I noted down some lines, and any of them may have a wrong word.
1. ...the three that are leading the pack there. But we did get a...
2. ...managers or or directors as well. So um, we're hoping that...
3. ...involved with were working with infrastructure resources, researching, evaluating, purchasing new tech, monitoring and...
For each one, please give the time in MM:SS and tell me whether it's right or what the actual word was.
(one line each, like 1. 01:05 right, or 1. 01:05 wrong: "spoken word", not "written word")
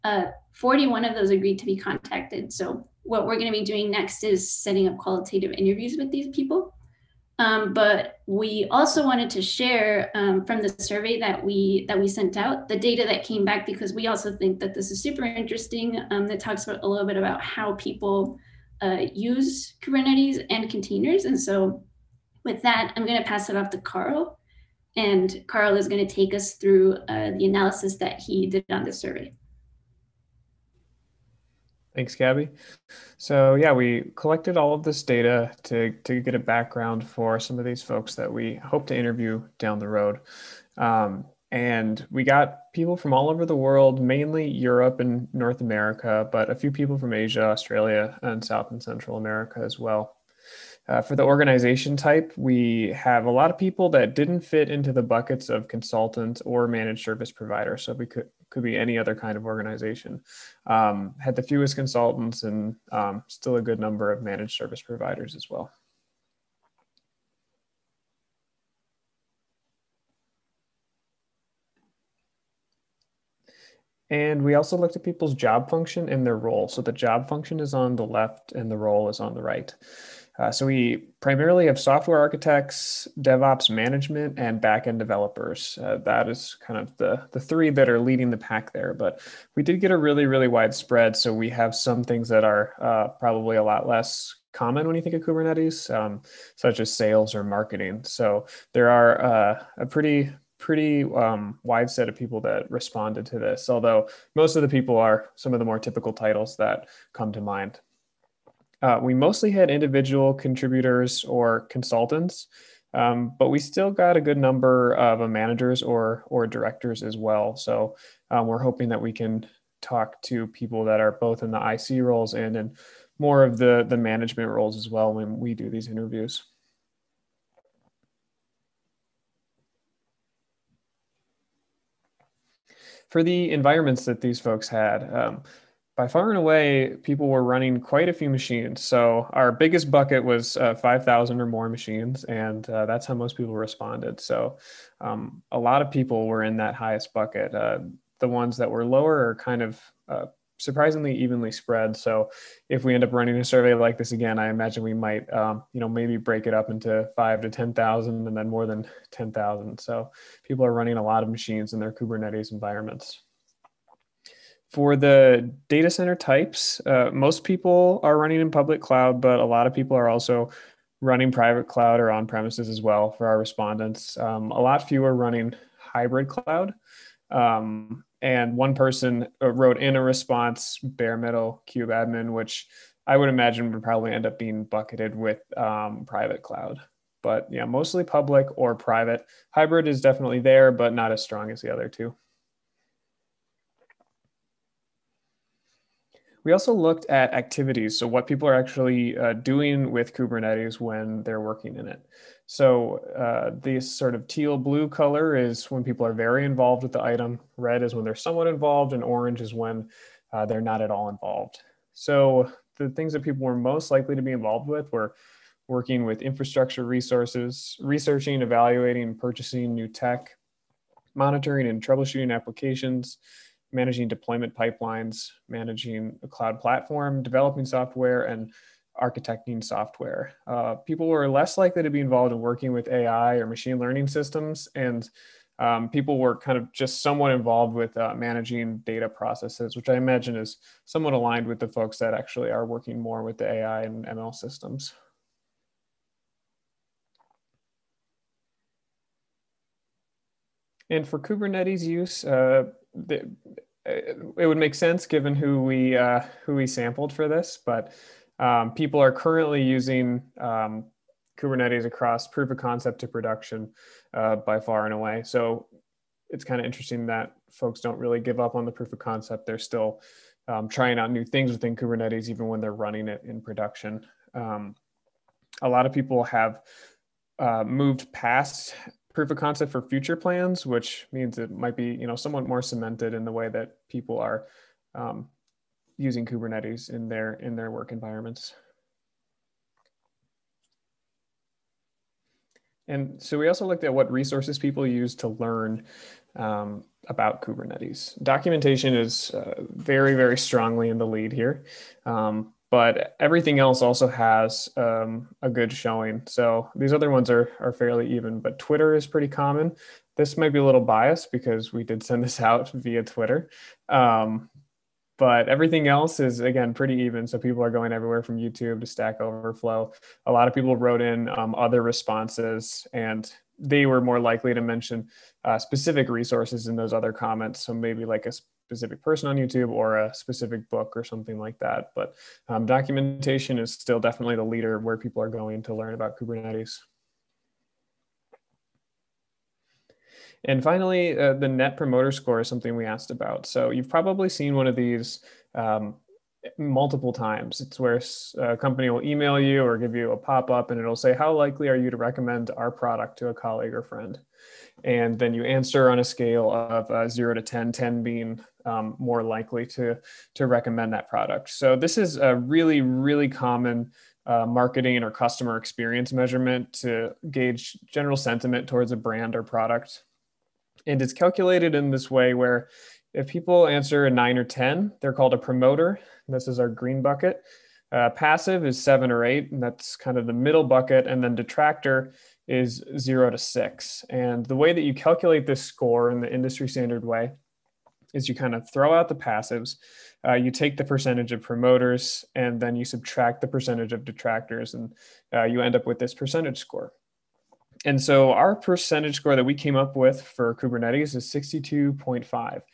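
1. 01:27 right
2. 01:55 right
3. 03:34 right.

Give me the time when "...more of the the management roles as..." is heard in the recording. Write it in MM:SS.
02:03.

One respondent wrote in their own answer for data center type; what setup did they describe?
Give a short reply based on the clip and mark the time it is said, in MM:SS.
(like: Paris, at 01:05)
bare metal kubeadm, at 03:00.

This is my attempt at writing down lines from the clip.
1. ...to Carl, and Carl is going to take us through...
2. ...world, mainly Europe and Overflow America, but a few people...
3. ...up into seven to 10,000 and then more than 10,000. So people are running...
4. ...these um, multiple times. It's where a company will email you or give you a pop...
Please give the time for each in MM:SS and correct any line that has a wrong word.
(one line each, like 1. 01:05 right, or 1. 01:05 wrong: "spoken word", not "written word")
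1. 00:23 right
2. 00:43 wrong: "North", not "Overflow"
3. 02:36 wrong: "five", not "seven"
4. 05:44 right.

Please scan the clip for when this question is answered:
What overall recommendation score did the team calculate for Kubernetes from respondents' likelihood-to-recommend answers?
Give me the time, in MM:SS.
06:41.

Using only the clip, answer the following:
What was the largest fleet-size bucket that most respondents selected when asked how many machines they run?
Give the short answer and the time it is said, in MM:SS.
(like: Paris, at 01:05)
5,000 or more, at 02:20.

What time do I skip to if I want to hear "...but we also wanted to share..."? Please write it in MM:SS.
00:07.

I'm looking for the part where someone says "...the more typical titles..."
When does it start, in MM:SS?
01:45.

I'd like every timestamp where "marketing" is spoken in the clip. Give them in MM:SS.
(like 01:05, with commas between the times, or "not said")
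01:37, 06:04.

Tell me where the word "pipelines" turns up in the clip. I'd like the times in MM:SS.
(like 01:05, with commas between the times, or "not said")
03:44.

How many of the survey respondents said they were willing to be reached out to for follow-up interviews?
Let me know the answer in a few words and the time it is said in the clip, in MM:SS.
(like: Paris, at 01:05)
41, at 00:00.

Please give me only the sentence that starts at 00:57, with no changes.
So we could could be any other kind of organization.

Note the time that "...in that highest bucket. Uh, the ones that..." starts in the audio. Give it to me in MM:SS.
02:26.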